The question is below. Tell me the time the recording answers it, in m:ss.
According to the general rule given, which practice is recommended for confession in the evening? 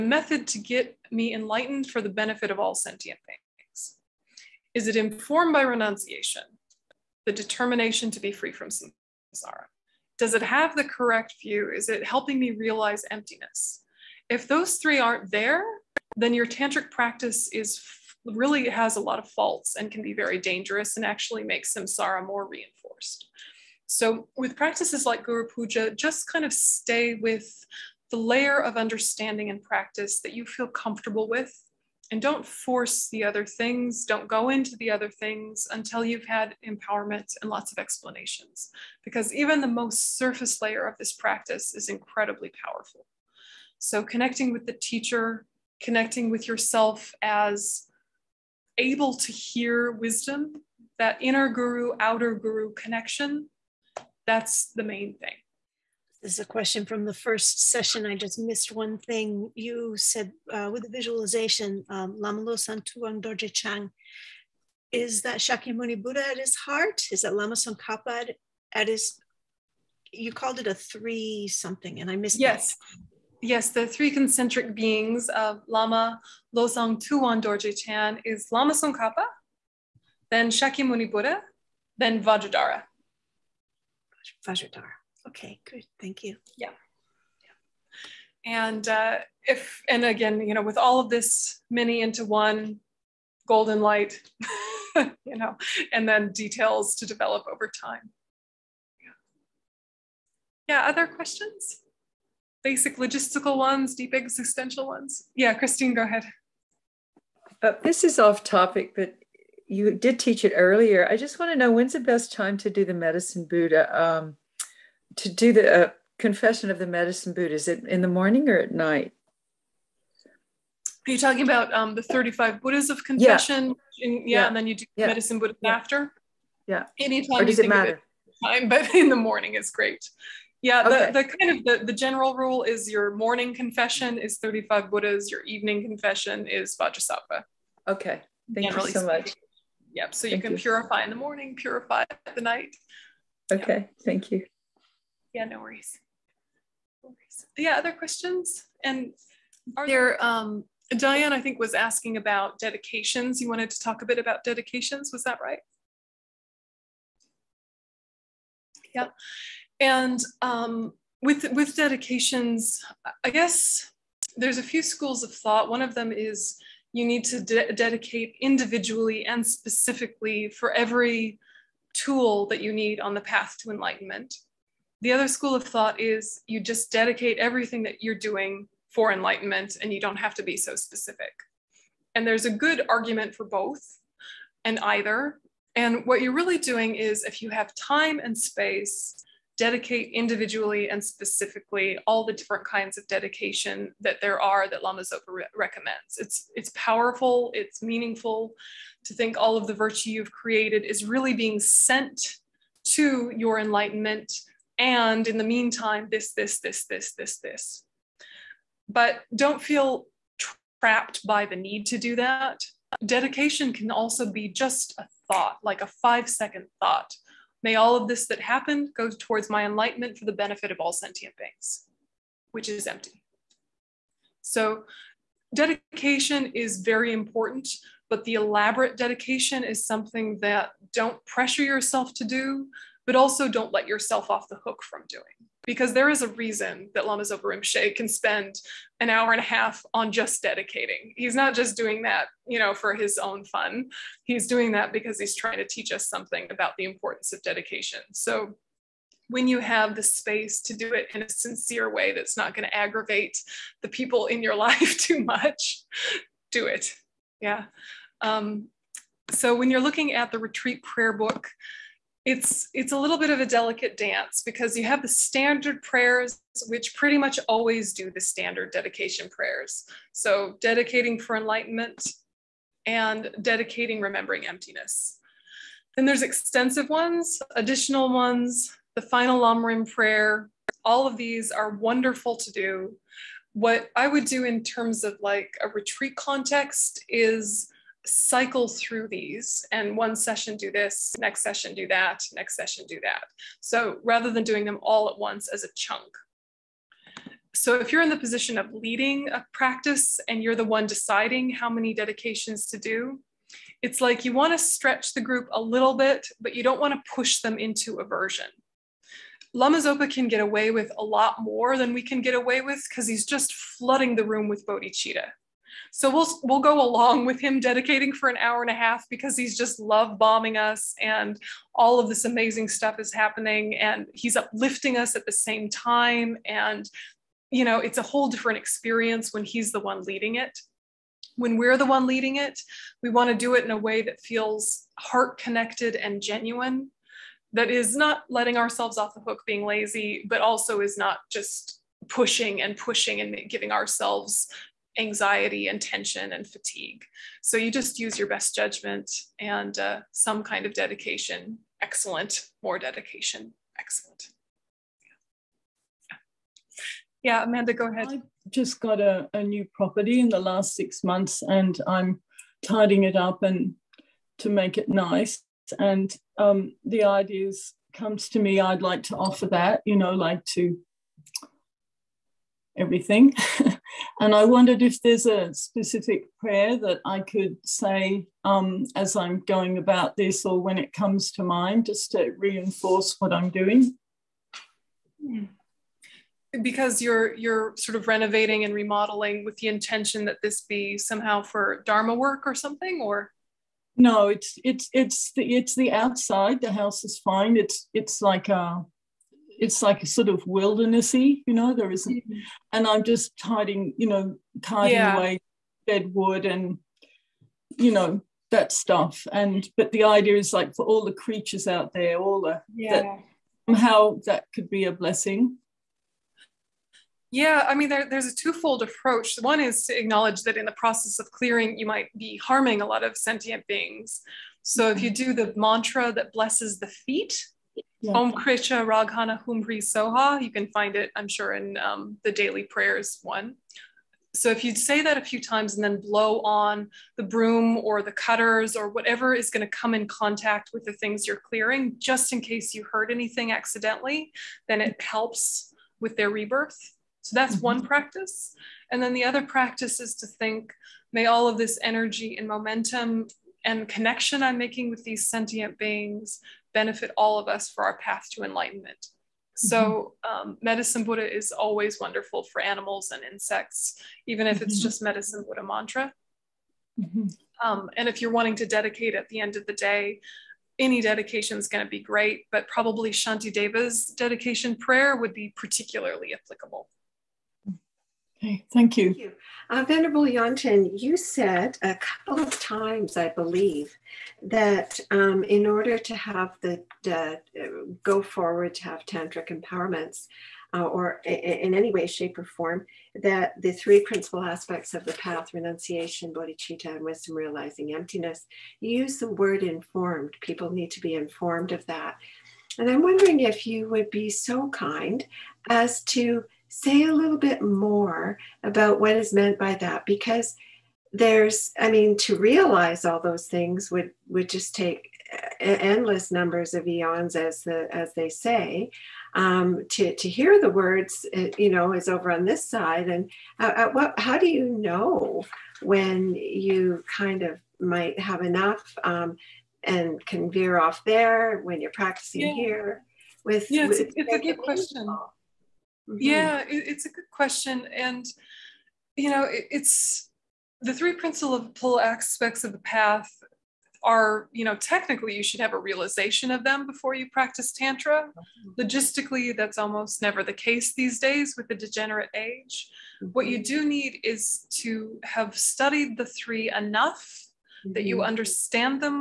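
2:16.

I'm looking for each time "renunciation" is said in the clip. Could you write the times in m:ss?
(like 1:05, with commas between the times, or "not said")
0:05, 8:15.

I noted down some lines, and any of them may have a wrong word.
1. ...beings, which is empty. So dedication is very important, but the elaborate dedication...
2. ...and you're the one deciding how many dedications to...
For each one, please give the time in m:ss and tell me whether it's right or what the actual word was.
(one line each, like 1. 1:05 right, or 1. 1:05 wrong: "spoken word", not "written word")
1. 3:41 right
2. 5:00 right.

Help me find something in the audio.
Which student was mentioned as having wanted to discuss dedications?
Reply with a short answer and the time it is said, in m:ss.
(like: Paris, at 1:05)
Diane, at 2:30.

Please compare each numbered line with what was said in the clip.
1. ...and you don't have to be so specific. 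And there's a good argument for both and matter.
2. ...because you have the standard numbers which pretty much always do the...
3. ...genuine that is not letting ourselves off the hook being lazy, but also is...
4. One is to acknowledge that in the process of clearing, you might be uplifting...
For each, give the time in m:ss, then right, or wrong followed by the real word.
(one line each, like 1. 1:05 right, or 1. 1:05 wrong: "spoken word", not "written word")
1. 2:59 wrong: "either", not "matter"
2. 4:24 wrong: "prayers", not "numbers"
3. 5:36 right
4. 6:59 wrong: "harming", not "uplifting".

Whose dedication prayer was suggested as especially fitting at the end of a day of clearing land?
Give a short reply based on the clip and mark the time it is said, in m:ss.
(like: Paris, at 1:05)
Shantideva, at 7:53.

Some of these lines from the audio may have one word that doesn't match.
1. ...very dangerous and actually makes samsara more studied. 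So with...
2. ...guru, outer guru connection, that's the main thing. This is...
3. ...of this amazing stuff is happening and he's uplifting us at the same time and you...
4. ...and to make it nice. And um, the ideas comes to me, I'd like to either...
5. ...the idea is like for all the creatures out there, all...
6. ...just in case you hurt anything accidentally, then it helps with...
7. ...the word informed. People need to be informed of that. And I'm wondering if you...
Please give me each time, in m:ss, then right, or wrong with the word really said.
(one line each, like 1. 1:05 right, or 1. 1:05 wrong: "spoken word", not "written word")
1. 0:20 wrong: "reinforced", not "studied"
2. 0:51 right
3. 5:21 right
4. 6:03 wrong: "offer", not "either"
5. 6:49 right
6. 7:21 right
7. 8:19 right.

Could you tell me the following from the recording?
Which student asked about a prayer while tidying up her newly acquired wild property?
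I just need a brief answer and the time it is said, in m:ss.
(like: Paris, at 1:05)
Amanda, at 5:57.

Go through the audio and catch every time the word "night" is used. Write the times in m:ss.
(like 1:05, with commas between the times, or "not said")
1:58, 2:22.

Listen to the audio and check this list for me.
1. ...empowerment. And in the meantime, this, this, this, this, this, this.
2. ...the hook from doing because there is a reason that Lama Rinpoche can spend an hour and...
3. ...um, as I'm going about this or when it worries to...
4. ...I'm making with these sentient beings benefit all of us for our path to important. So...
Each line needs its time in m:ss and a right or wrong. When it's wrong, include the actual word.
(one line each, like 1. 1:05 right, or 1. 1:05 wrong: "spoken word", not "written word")
1. 3:23 wrong: "enlightenment", not "empowerment"
2. 3:54 right
3. 6:18 wrong: "comes", not "worries"
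4. 7:34 wrong: "enlightenment", not "important".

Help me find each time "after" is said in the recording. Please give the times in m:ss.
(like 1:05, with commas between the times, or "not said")
2:05.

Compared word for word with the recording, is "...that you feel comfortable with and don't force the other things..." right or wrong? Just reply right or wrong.
right.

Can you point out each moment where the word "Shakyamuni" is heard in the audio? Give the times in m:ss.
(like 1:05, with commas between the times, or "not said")
1:05, 1:20.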